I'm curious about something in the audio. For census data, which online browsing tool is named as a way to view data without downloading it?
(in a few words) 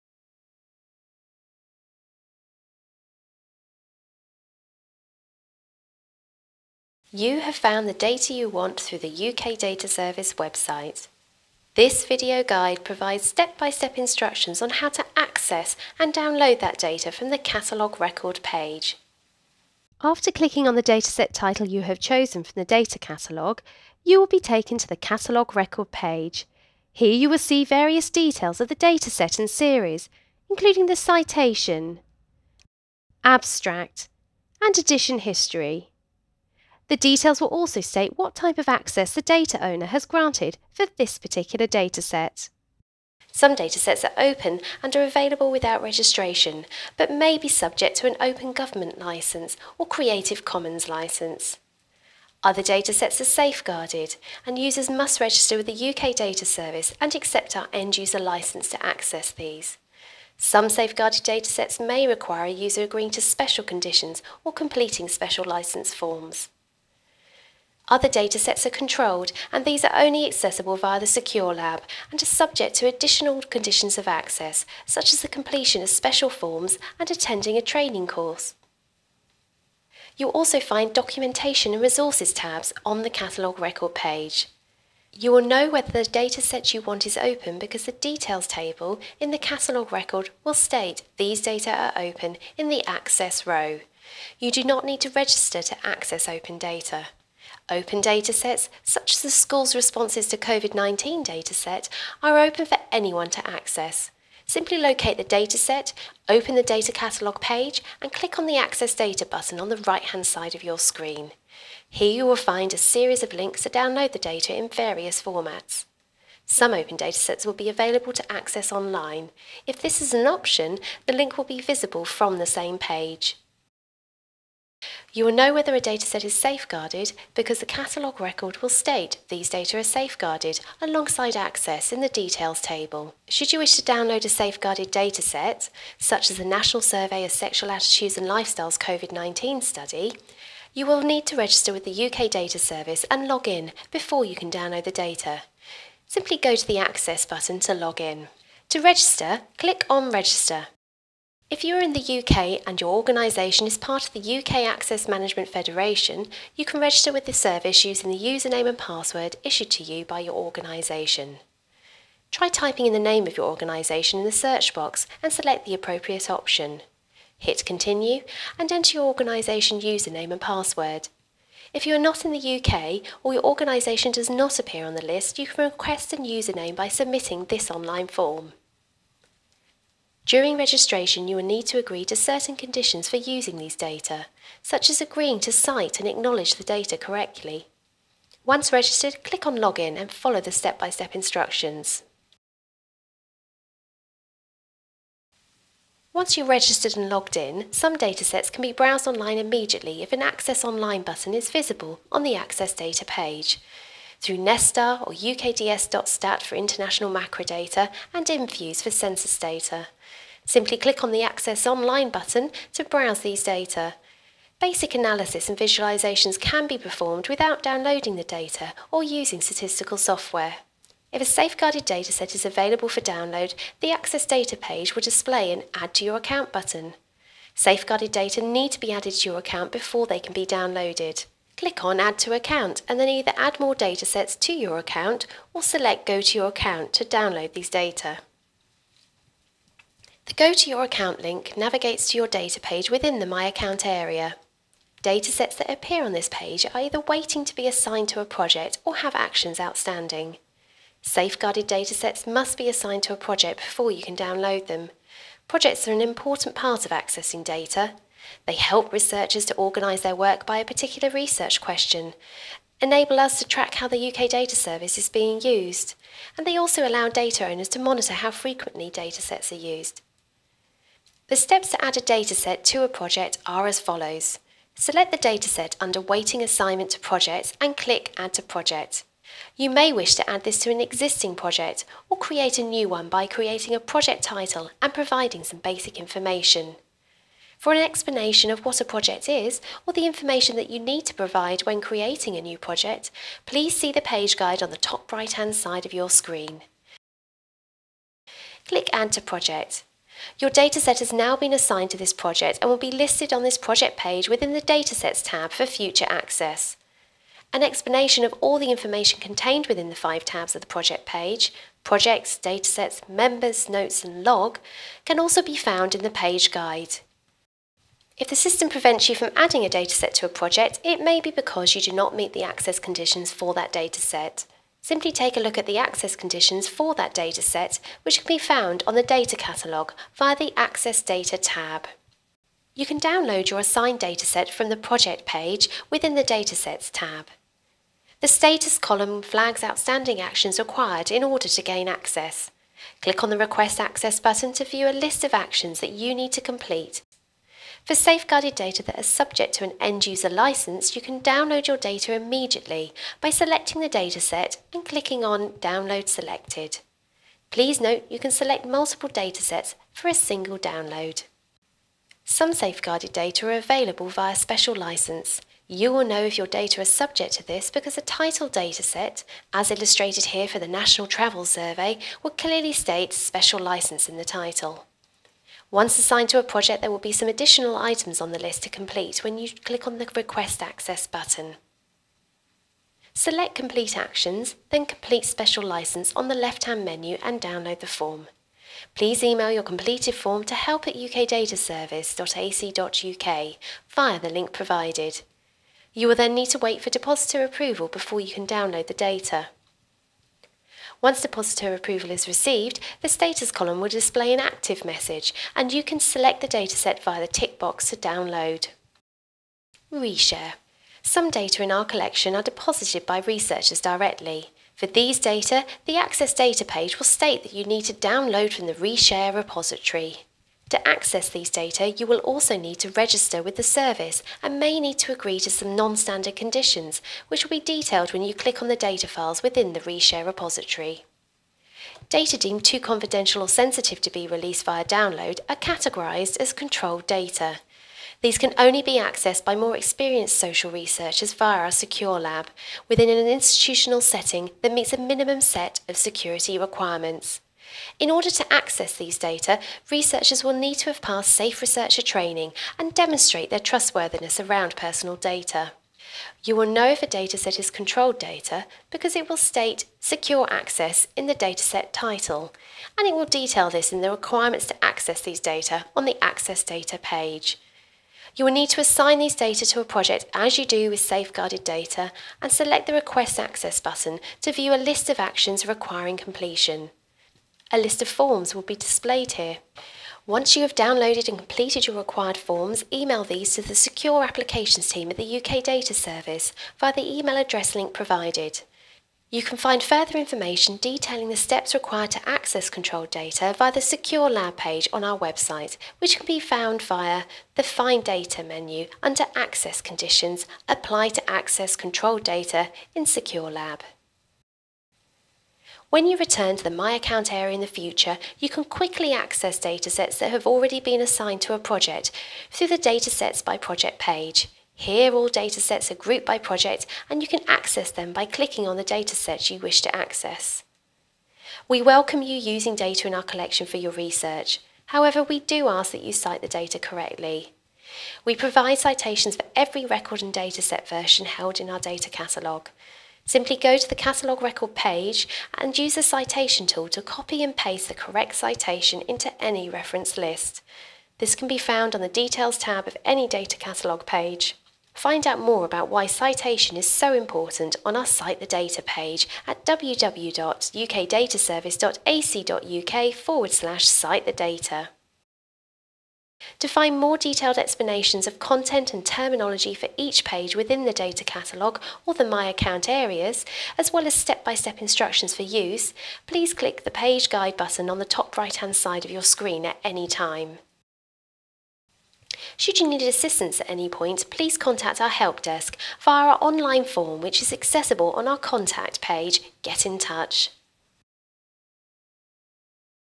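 Infuse.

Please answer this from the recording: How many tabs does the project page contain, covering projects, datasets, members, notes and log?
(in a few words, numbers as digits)
5.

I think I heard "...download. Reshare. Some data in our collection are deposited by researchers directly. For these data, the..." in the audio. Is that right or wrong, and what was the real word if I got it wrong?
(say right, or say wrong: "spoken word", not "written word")
right.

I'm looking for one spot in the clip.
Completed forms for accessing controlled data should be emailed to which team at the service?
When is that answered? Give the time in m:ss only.
8:03.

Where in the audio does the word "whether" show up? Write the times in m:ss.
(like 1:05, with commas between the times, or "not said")
1:25, 2:05.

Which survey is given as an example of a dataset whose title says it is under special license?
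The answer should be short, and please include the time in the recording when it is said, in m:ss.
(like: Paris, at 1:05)
National Travel Survey, at 6:10.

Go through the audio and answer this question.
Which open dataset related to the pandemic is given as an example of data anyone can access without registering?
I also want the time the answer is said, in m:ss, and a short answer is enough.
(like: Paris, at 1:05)
School's responses to COVID-19, at 1:39.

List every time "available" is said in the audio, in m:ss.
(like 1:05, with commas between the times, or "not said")
0:45, 1:57, 3:42, 6:03.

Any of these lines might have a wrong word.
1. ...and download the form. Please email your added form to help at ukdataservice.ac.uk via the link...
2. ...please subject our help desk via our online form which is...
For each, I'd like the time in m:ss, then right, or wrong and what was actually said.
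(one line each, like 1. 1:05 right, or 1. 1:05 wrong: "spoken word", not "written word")
1. 6:27 wrong: "completed", not "added"
2. 9:34 wrong: "contact", not "subject".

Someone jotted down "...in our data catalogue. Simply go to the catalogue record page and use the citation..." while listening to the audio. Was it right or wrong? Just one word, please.
right.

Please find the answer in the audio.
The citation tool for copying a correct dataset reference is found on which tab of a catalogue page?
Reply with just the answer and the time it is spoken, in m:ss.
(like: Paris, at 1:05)
Details tab, at 9:02.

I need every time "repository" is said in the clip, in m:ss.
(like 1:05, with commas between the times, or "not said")
6:59, 7:10.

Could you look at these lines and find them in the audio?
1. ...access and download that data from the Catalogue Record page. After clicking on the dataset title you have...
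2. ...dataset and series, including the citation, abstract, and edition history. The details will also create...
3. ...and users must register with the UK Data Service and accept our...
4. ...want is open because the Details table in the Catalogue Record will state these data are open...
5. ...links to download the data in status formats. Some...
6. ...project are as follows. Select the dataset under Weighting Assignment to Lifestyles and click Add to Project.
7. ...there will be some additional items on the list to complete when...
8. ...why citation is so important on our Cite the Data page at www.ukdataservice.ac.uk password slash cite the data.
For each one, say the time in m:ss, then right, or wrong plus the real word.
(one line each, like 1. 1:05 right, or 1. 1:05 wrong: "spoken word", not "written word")
1. 0:15 right
2. 0:28 wrong: "state", not "create"
3. 0:54 right
4. 1:26 right
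5. 1:53 wrong: "various", not "status"
6. 4:32 wrong: "Projects", not "Lifestyles"
7. 6:16 right
8. 9:05 wrong: "forward", not "password".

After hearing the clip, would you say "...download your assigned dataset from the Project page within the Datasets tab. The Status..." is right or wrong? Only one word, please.
right.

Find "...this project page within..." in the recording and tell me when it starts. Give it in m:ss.
5:03.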